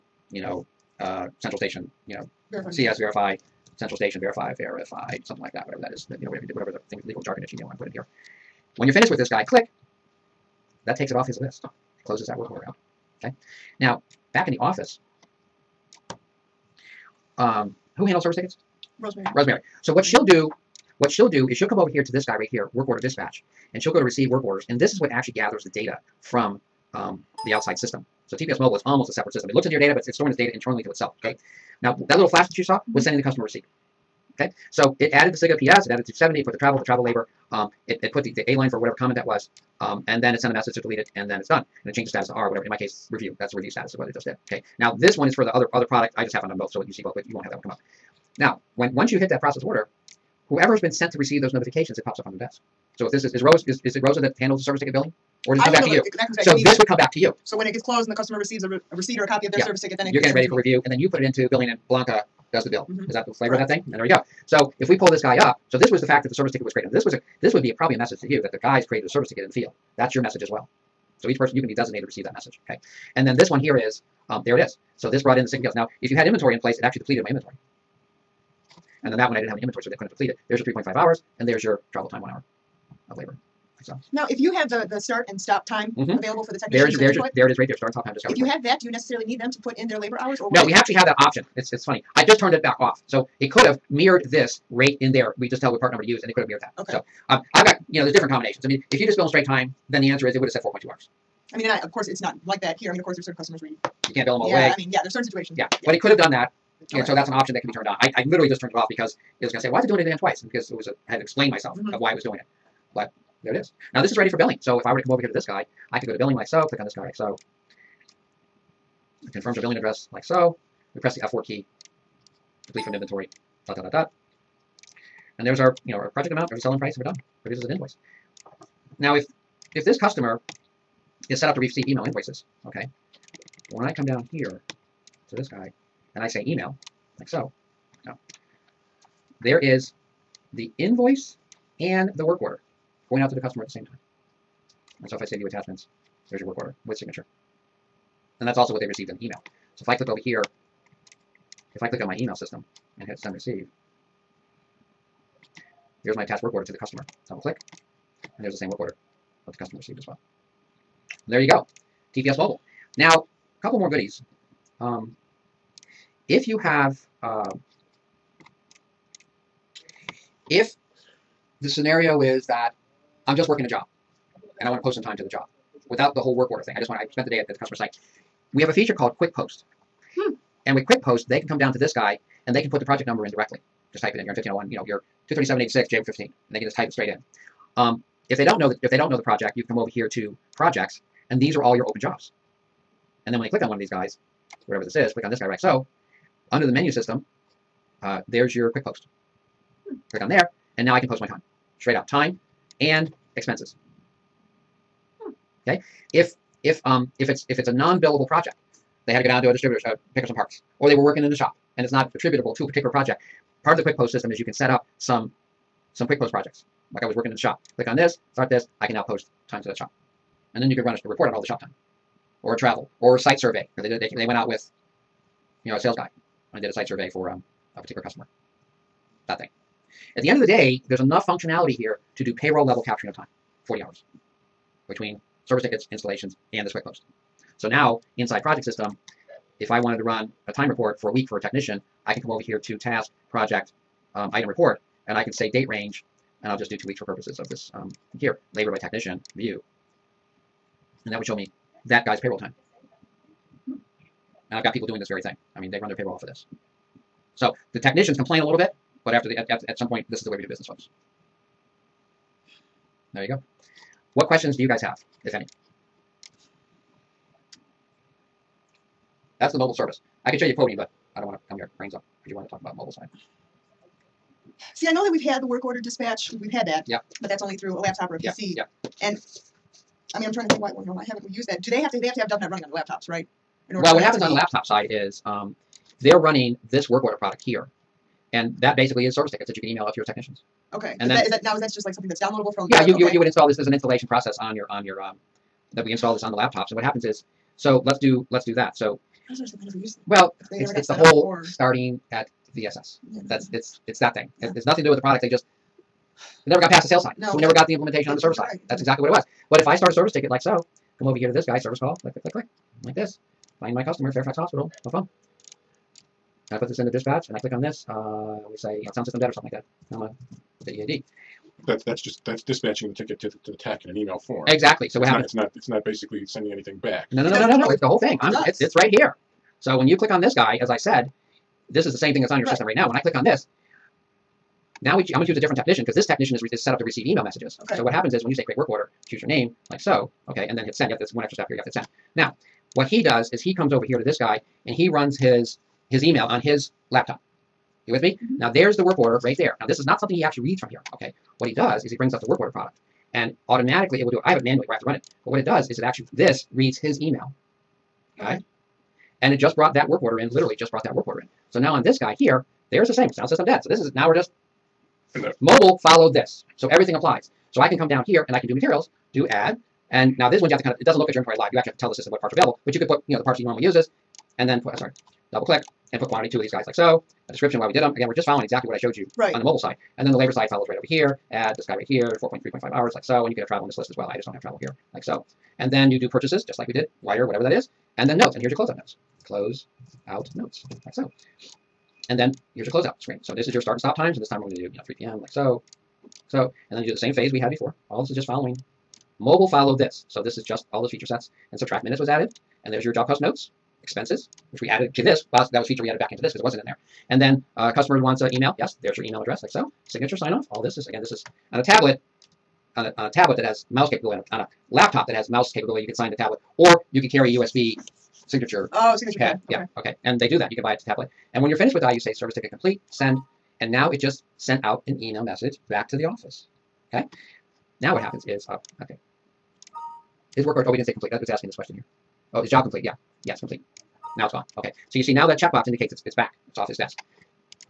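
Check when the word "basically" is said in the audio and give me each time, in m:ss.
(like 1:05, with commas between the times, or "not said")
4:48, 5:25.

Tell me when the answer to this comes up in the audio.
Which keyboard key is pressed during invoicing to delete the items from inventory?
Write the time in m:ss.
2:01.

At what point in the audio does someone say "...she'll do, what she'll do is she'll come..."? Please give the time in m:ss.
0:20.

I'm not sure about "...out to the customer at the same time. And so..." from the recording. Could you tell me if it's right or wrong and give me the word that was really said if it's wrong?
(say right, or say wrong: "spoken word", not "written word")
right.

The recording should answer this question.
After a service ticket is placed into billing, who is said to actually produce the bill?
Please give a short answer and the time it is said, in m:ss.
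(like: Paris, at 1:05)
Blanca, at 1:01.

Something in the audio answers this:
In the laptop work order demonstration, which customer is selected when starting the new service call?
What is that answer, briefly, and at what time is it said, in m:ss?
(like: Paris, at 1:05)
Fairfax Hospital, at 5:14.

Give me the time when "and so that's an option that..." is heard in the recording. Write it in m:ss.
1:46.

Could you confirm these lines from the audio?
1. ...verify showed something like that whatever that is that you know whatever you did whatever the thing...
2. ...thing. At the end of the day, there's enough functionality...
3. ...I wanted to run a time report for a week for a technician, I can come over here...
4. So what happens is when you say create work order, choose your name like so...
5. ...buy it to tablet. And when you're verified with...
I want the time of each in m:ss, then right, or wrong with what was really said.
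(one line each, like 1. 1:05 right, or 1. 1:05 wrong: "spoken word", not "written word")
1. 0:04 wrong: "verified", not "showed"
2. 3:49 right
3. 3:59 right
4. 5:37 right
5. 7:00 wrong: "finished", not "verified".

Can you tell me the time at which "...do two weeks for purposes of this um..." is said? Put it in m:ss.
4:06.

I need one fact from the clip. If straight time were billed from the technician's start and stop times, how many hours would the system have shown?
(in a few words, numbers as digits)
4.2 hours.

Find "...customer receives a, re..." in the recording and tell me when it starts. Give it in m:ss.
0:58.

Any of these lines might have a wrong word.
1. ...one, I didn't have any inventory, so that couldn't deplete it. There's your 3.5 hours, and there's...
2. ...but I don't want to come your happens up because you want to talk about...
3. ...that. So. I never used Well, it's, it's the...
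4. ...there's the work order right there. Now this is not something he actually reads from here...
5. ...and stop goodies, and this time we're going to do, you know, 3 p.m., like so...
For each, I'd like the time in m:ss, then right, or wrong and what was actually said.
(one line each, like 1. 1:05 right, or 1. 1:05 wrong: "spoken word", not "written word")
1. 1:19 right
2. 4:30 wrong: "brains", not "happens"
3. 4:58 right
4. 5:48 right
5. 6:33 wrong: "times", not "goodies".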